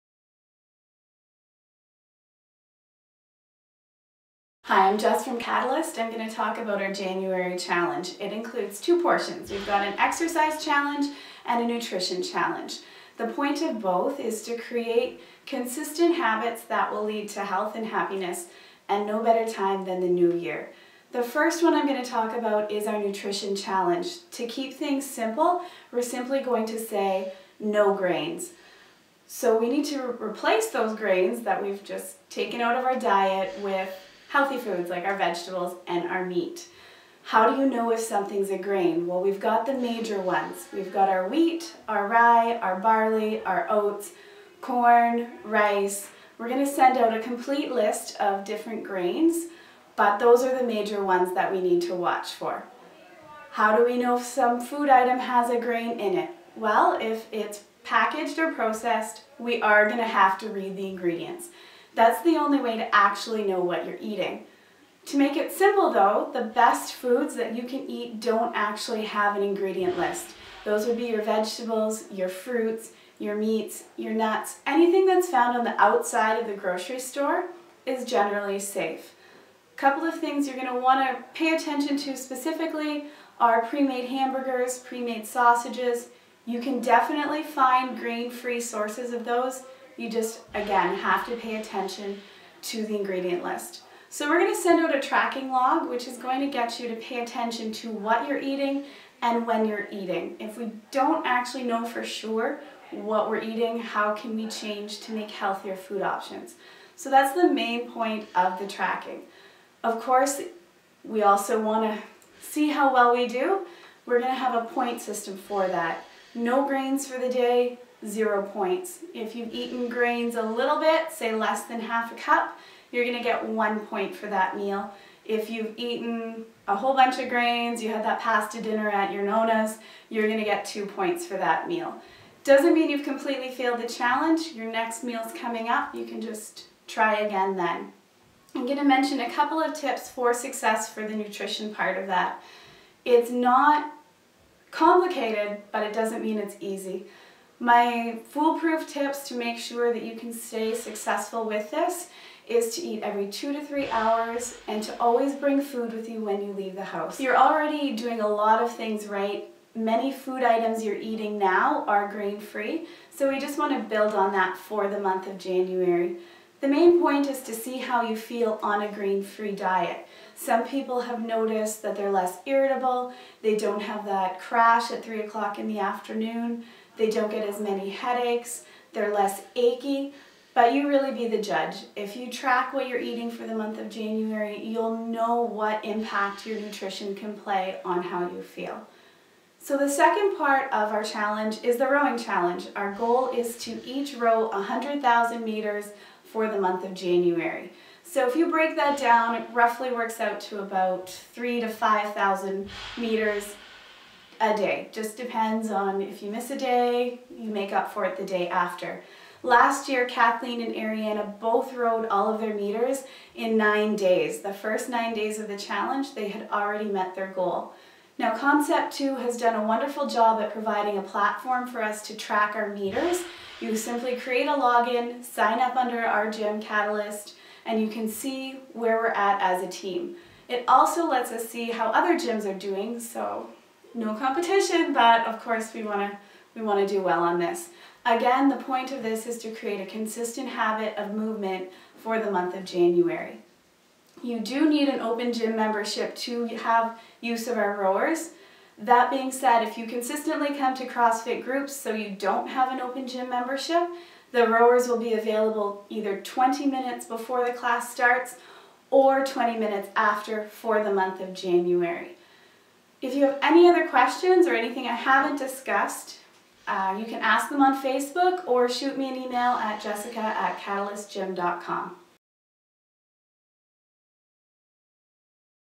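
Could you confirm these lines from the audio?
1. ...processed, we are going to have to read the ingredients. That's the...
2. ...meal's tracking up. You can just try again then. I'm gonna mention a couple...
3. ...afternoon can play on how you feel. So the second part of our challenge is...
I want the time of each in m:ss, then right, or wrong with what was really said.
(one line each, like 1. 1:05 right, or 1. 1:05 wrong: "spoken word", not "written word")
1. 0:58 right
2. 2:15 wrong: "coming", not "tracking"
3. 3:06 wrong: "nutrition", not "afternoon".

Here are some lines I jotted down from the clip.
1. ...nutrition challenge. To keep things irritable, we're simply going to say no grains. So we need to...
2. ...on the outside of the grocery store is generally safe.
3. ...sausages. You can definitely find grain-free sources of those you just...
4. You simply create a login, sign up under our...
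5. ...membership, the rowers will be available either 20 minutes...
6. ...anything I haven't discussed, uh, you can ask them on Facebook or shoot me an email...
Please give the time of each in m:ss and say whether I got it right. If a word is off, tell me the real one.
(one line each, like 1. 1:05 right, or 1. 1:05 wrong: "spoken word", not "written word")
1. 0:22 wrong: "simple", not "irritable"
2. 1:15 right
3. 1:25 right
4. 3:43 right
5. 4:13 right
6. 4:24 right.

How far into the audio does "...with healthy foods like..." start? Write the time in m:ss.
0:33.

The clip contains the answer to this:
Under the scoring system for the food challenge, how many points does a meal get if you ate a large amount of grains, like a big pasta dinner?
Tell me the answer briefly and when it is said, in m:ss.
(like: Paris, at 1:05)
2, at 2:10.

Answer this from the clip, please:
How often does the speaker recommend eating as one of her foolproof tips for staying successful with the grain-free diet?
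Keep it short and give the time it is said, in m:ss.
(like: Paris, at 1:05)
every 2 to 3 hours, at 2:33.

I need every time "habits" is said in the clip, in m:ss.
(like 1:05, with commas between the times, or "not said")
0:16, 4:00.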